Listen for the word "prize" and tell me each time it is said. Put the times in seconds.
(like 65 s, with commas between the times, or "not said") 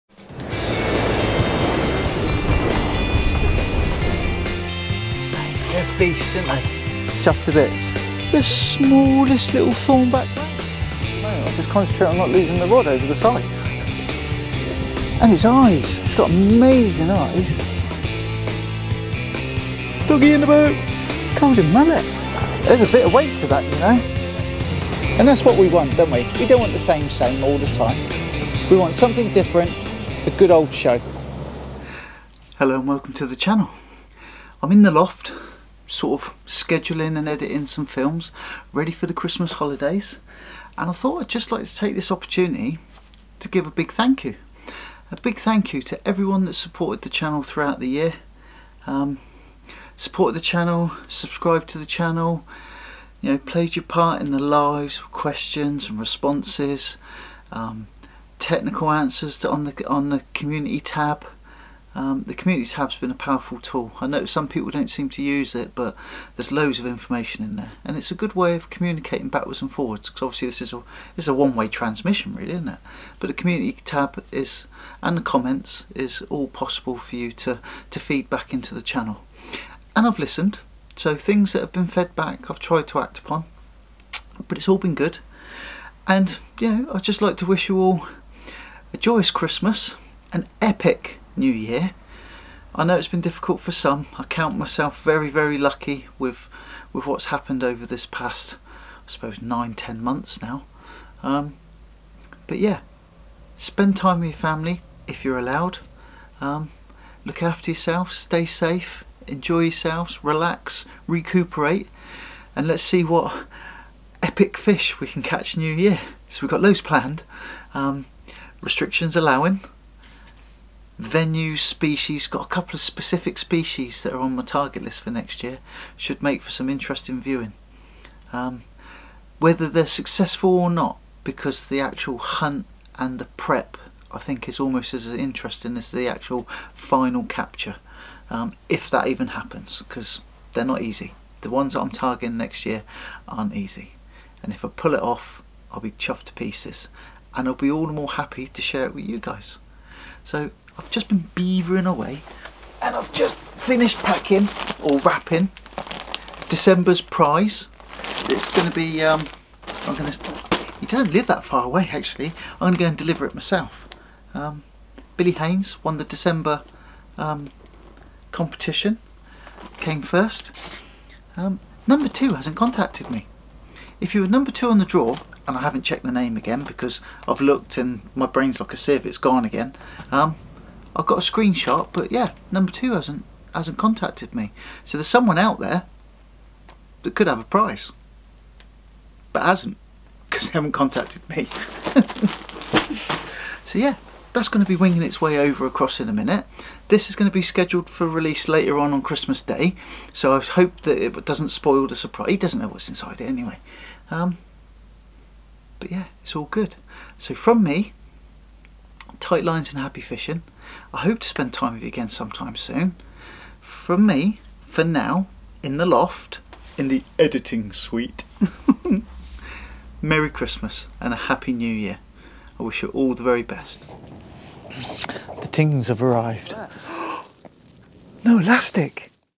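157 s, 187 s.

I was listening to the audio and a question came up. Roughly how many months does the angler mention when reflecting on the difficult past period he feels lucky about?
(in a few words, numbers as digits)
9 or 10 months.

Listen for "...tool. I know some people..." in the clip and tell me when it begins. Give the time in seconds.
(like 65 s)
63 s.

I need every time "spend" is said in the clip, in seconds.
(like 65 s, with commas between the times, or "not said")
103 s, 211 s.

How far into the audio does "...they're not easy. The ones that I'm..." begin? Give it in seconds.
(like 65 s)
140 s.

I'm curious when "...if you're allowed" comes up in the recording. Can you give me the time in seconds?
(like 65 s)
105 s.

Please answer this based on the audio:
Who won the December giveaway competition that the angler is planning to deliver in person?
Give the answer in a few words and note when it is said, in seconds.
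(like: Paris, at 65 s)
Billy Haynes, at 165 s.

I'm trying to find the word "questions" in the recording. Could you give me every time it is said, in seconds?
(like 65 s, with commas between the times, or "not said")
55 s.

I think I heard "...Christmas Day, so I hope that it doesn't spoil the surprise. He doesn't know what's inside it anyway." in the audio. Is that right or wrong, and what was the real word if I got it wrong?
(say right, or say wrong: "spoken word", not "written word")
right.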